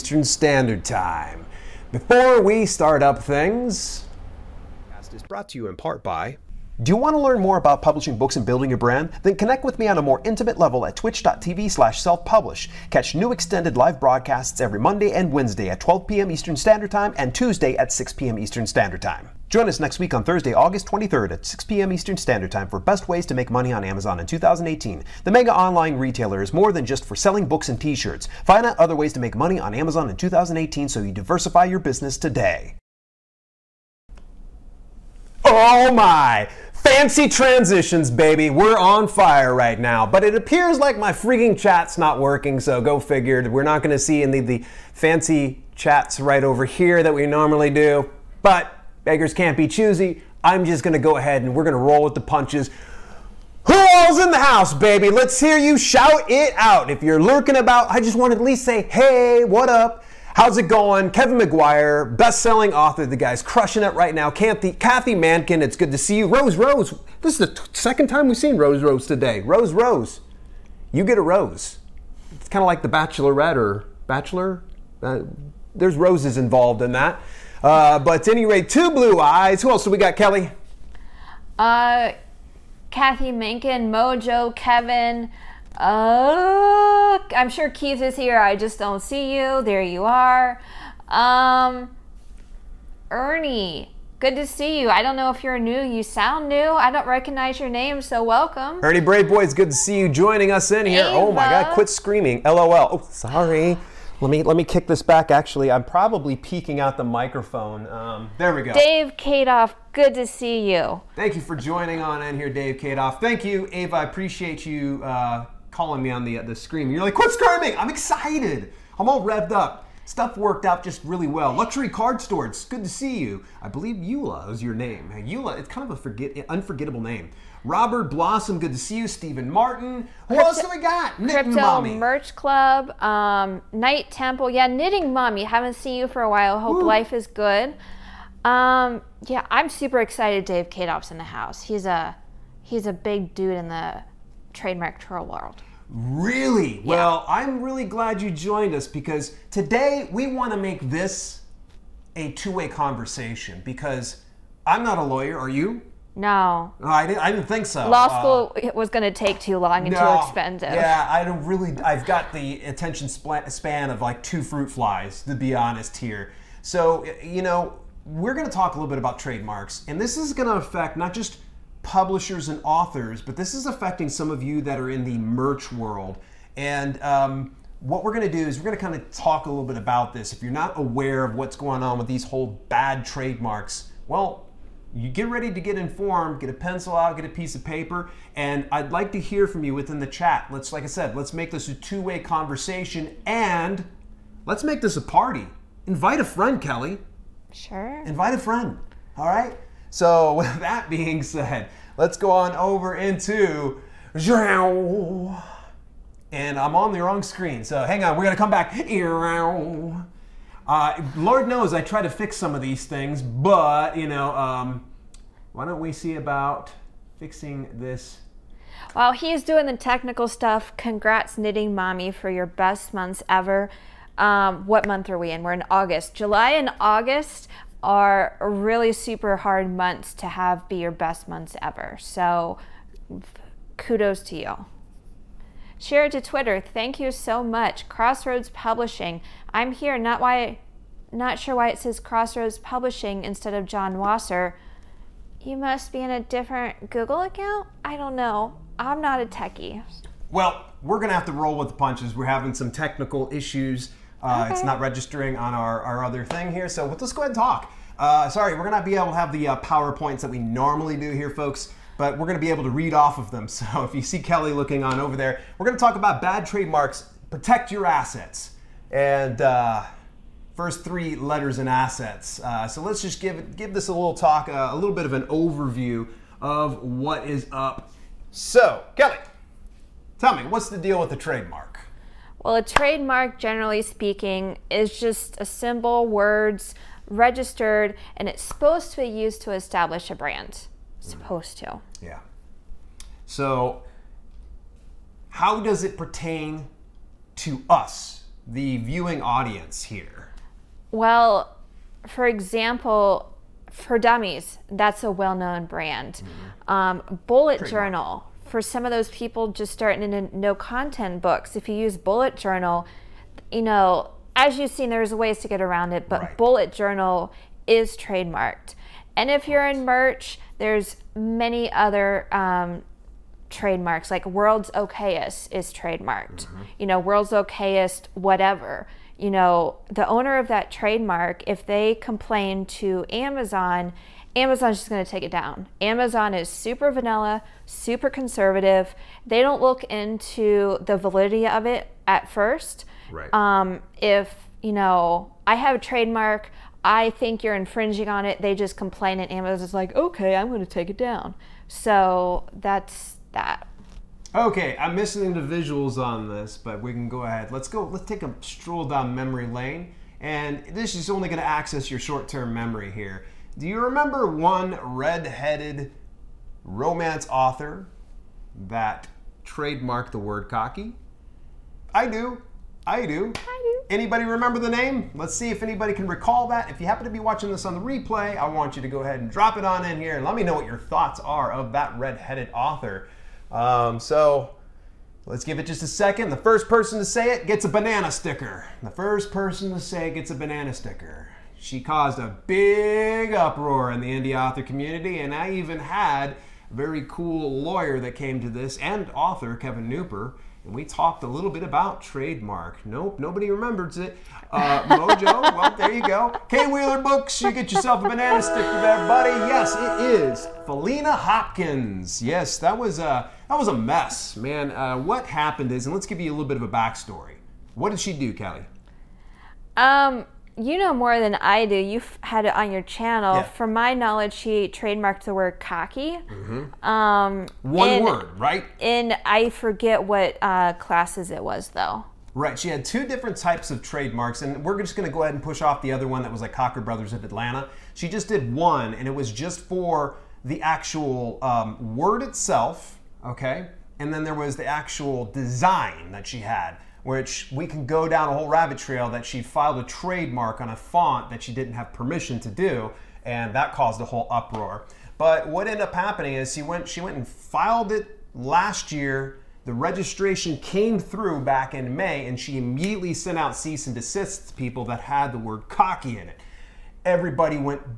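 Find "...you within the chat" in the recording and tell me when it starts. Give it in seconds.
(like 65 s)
189 s.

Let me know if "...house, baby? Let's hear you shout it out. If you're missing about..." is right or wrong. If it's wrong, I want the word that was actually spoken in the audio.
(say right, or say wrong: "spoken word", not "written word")
wrong: "lurking", not "missing".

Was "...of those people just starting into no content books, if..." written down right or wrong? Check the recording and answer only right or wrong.
right.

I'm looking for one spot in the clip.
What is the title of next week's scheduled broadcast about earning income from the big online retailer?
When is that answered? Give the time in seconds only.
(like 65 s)
22 s.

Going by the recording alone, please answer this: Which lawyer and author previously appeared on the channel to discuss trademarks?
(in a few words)
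Kevin Kneupper.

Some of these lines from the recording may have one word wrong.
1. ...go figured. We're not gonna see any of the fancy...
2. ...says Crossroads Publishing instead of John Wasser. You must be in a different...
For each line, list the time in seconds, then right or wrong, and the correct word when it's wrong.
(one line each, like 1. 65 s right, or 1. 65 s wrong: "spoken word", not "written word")
1. 42 s right
2. 241 s right.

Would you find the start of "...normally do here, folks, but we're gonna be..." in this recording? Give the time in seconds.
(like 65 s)
260 s.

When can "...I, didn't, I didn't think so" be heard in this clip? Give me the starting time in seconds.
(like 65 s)
156 s.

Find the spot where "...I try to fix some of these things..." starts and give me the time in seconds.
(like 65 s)
211 s.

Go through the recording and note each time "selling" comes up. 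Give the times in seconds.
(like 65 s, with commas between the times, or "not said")
27 s, 62 s.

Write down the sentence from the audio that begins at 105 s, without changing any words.
Actually, I'm probably peeking out the microphone.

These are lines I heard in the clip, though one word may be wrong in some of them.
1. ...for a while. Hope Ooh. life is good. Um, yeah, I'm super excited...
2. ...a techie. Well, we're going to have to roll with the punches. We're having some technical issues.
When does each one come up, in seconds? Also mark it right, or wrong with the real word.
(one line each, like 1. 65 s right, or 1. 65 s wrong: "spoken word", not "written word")
1. 136 s right
2. 249 s right.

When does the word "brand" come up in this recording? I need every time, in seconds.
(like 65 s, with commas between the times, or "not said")
8 s, 290 s, 305 s.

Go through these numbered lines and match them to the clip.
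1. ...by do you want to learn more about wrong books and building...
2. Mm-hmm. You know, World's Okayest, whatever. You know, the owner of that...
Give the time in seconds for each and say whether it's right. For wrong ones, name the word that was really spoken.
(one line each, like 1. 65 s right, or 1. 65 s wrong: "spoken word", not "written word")
1. 6 s wrong: "publishing", not "wrong"
2. 326 s right.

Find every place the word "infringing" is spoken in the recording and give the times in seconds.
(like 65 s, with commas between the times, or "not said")
347 s.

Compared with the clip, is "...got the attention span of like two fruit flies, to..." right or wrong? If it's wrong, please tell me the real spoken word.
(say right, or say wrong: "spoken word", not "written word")
right.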